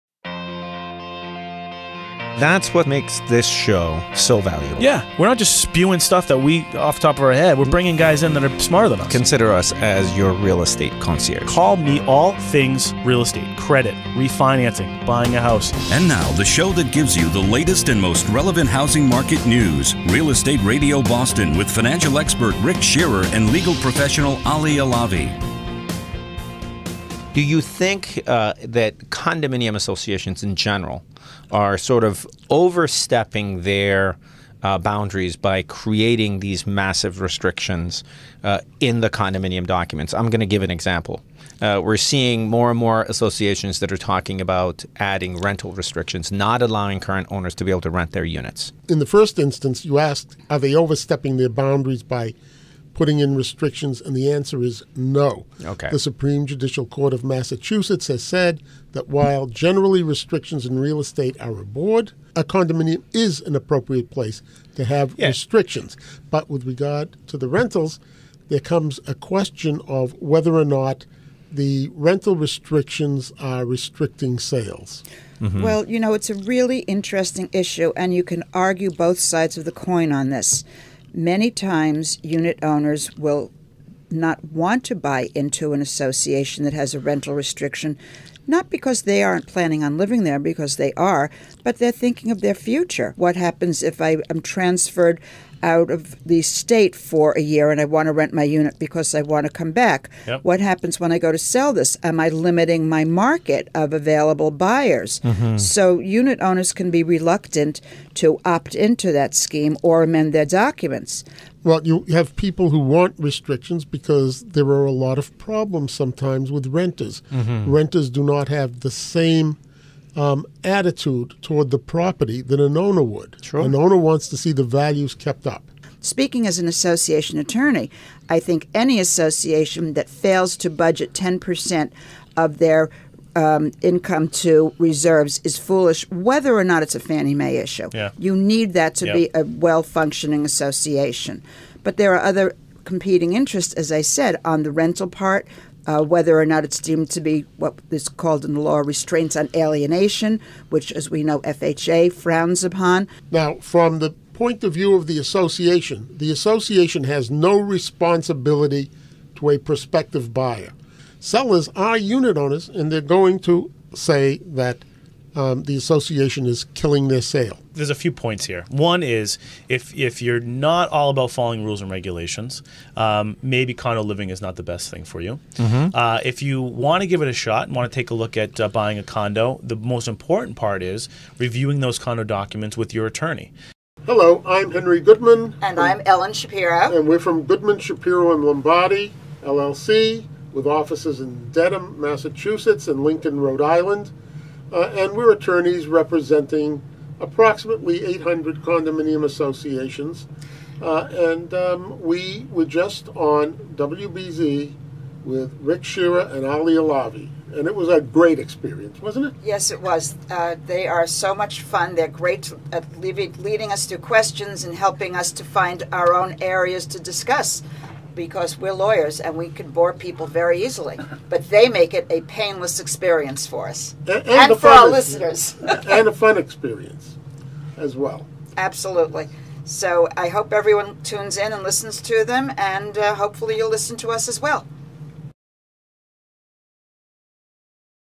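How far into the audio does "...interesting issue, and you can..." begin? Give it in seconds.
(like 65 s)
76 s.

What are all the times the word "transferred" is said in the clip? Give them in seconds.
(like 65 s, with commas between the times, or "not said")
94 s.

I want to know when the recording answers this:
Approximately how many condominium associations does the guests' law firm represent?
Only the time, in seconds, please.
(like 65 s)
198 s.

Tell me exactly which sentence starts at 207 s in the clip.
And it was a great experience, wasn't it?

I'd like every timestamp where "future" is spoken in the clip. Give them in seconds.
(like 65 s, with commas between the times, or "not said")
92 s.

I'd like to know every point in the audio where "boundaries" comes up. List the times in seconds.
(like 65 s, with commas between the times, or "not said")
34 s, 51 s.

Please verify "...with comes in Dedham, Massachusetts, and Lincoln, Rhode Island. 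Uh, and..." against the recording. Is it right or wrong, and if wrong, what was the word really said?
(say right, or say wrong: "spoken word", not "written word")
wrong: "offices", not "comes".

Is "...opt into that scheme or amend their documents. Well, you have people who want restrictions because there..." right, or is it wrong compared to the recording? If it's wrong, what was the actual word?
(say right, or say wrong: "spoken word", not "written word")
right.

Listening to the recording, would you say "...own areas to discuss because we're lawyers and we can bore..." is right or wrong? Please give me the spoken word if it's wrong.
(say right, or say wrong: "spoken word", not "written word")
right.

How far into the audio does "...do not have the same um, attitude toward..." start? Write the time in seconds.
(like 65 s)
118 s.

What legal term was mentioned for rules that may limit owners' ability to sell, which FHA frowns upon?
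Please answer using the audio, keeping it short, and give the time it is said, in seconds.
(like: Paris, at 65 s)
restraints on alienation, at 148 s.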